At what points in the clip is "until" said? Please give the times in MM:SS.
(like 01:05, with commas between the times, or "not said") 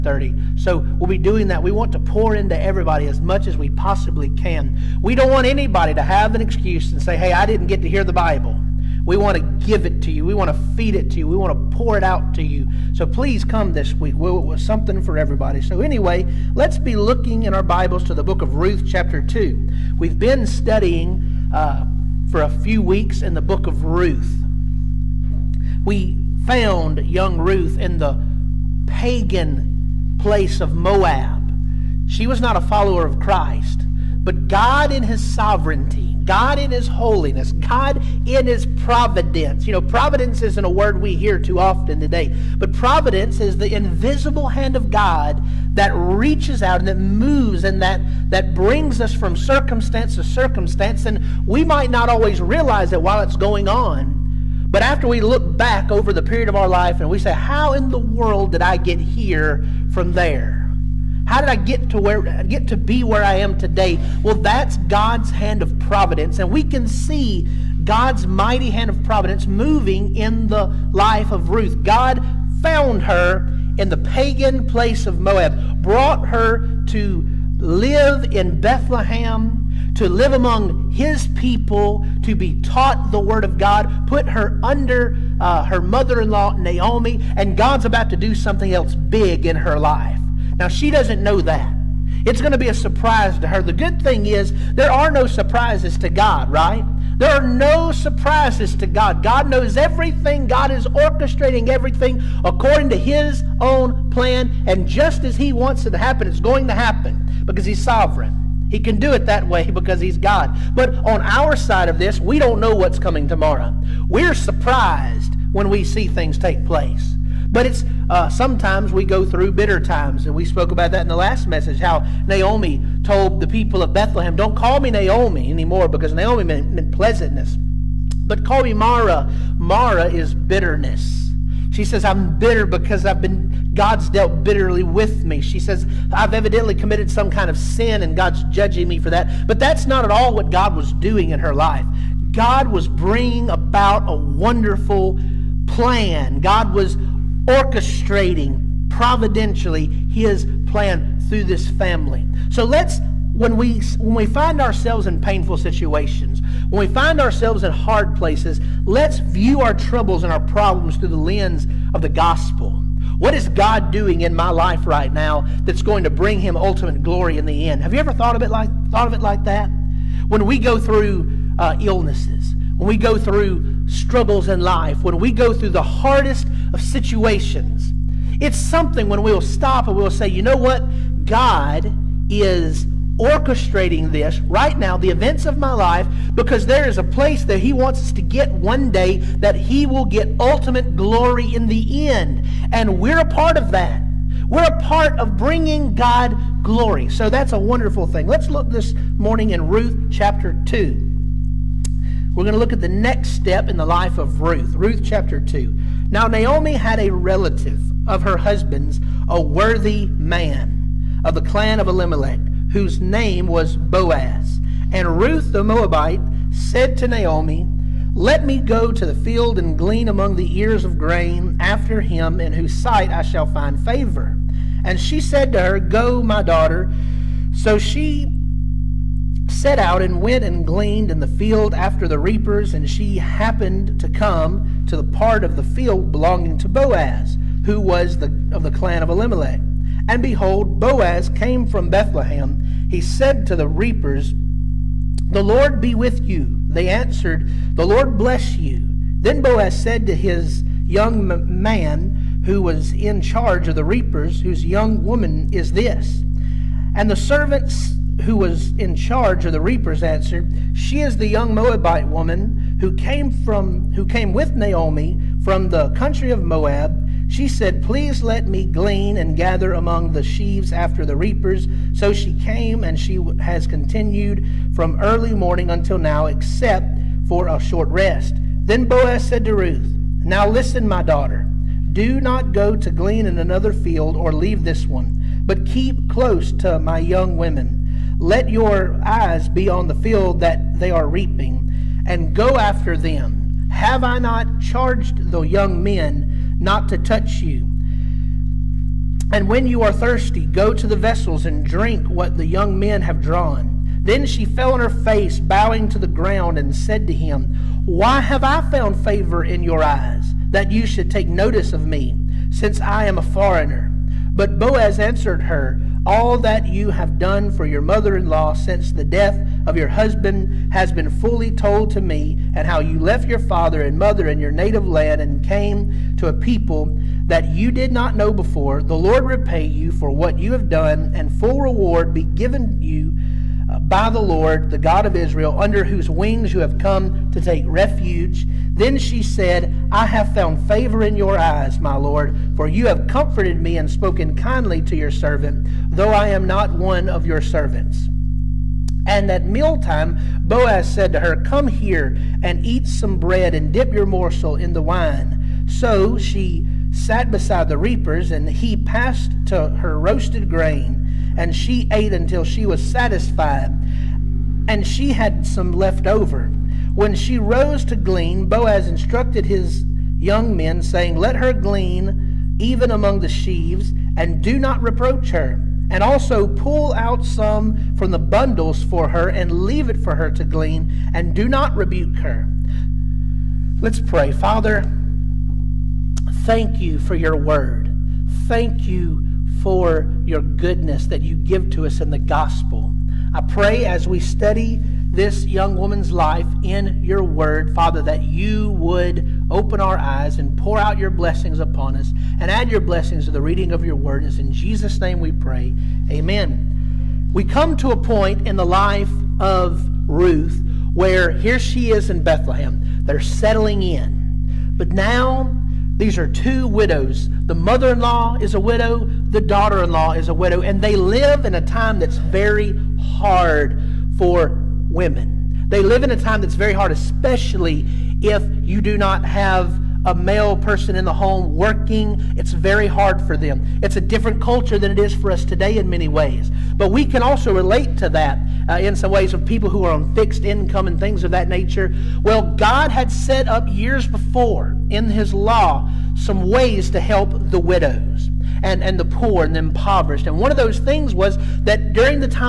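04:35, 06:02.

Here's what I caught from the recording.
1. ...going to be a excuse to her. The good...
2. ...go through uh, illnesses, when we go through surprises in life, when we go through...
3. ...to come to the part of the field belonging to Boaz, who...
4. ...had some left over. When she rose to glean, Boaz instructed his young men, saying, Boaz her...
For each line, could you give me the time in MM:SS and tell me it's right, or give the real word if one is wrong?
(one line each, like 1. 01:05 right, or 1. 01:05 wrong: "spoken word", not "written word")
1. 01:32 wrong: "surprise", not "excuse"
2. 02:50 wrong: "struggles", not "surprises"
3. 03:53 right
4. 06:05 wrong: "Let", not "Boaz".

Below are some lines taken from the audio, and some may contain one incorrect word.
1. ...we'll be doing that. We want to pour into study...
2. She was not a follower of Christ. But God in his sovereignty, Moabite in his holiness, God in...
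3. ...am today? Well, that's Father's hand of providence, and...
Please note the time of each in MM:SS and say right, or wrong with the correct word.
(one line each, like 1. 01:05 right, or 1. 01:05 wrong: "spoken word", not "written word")
1. 00:00 wrong: "everybody", not "study"
2. 00:32 wrong: "God", not "Moabite"
3. 01:03 wrong: "God", not "Father".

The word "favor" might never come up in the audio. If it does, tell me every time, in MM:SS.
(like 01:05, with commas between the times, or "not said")
03:43, 05:08, 05:40.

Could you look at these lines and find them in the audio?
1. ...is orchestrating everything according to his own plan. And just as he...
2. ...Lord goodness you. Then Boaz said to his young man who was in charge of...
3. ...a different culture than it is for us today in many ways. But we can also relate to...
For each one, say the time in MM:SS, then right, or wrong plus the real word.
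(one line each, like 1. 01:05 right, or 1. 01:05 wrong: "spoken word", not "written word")
1. 01:40 right
2. 04:07 wrong: "bless", not "goodness"
3. 07:13 right.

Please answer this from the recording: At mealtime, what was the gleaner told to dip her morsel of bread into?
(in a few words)
Wine.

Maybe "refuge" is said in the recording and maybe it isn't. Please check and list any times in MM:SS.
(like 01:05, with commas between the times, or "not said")
05:37.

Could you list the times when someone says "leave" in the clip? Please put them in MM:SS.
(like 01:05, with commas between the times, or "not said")
04:44, 06:19.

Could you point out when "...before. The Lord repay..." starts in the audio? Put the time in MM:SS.
05:28.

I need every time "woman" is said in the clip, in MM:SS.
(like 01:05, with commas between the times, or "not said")
04:15, 04:22, 06:35.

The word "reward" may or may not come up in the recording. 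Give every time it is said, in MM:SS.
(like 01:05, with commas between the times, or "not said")
05:31.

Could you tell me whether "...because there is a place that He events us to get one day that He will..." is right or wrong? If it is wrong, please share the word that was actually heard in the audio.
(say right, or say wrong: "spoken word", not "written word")
wrong: "wants", not "events".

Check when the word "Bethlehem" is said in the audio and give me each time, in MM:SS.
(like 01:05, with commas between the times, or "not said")
01:18, 02:03, 04:01, 06:52.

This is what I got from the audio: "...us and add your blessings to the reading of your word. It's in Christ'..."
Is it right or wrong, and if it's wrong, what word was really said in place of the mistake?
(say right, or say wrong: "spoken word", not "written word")
wrong: "Jesus", not "Christ".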